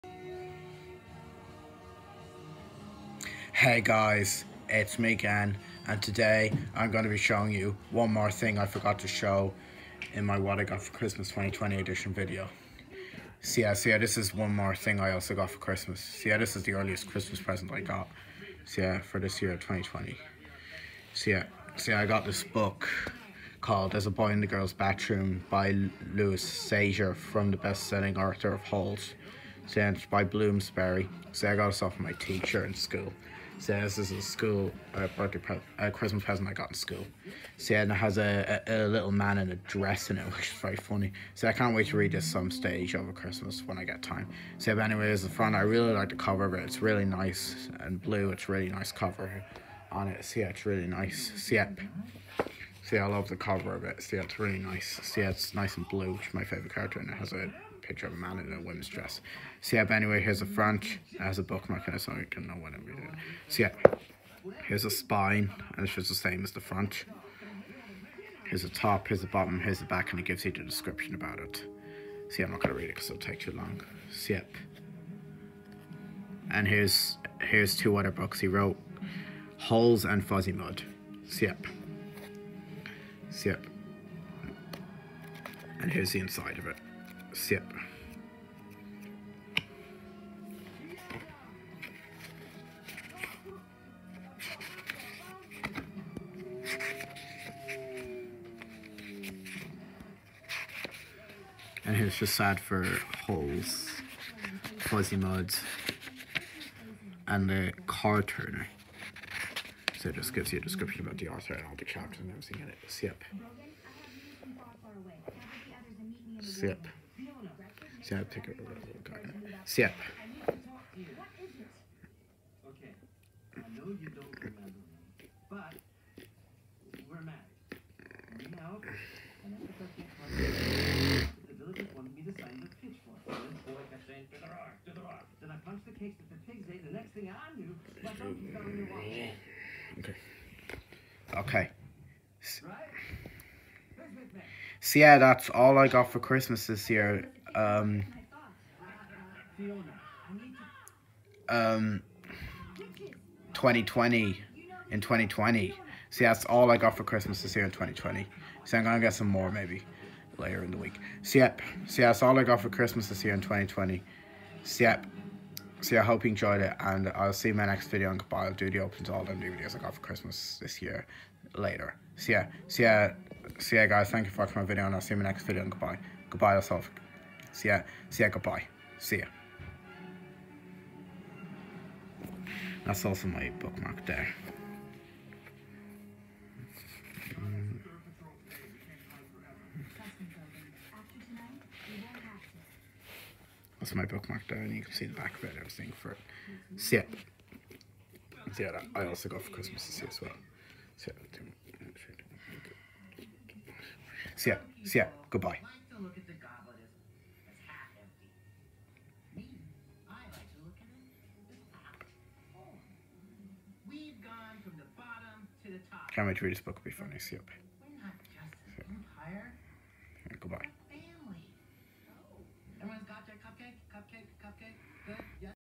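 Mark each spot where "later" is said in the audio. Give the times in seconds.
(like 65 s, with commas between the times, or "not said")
160 s, 171 s.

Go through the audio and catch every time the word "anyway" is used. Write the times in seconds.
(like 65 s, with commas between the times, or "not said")
44 s, 59 s.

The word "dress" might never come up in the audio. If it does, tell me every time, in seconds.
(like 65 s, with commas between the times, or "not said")
39 s, 58 s.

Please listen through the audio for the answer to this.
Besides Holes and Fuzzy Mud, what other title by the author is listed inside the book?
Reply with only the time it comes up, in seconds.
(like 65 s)
107 s.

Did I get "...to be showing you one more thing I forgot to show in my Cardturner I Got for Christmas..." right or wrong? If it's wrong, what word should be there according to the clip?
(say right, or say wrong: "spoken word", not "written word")
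wrong: "What", not "Cardturner".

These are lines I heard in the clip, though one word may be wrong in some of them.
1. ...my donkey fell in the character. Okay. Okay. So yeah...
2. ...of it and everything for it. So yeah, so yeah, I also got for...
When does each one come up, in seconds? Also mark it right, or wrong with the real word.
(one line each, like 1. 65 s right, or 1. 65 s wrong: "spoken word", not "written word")
1. 138 s wrong: "water", not "character"
2. 195 s right.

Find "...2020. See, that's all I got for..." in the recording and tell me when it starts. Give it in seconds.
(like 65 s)
155 s.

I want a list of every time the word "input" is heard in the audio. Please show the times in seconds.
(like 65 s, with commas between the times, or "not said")
not said.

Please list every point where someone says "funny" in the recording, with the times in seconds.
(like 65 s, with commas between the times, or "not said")
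40 s, 216 s.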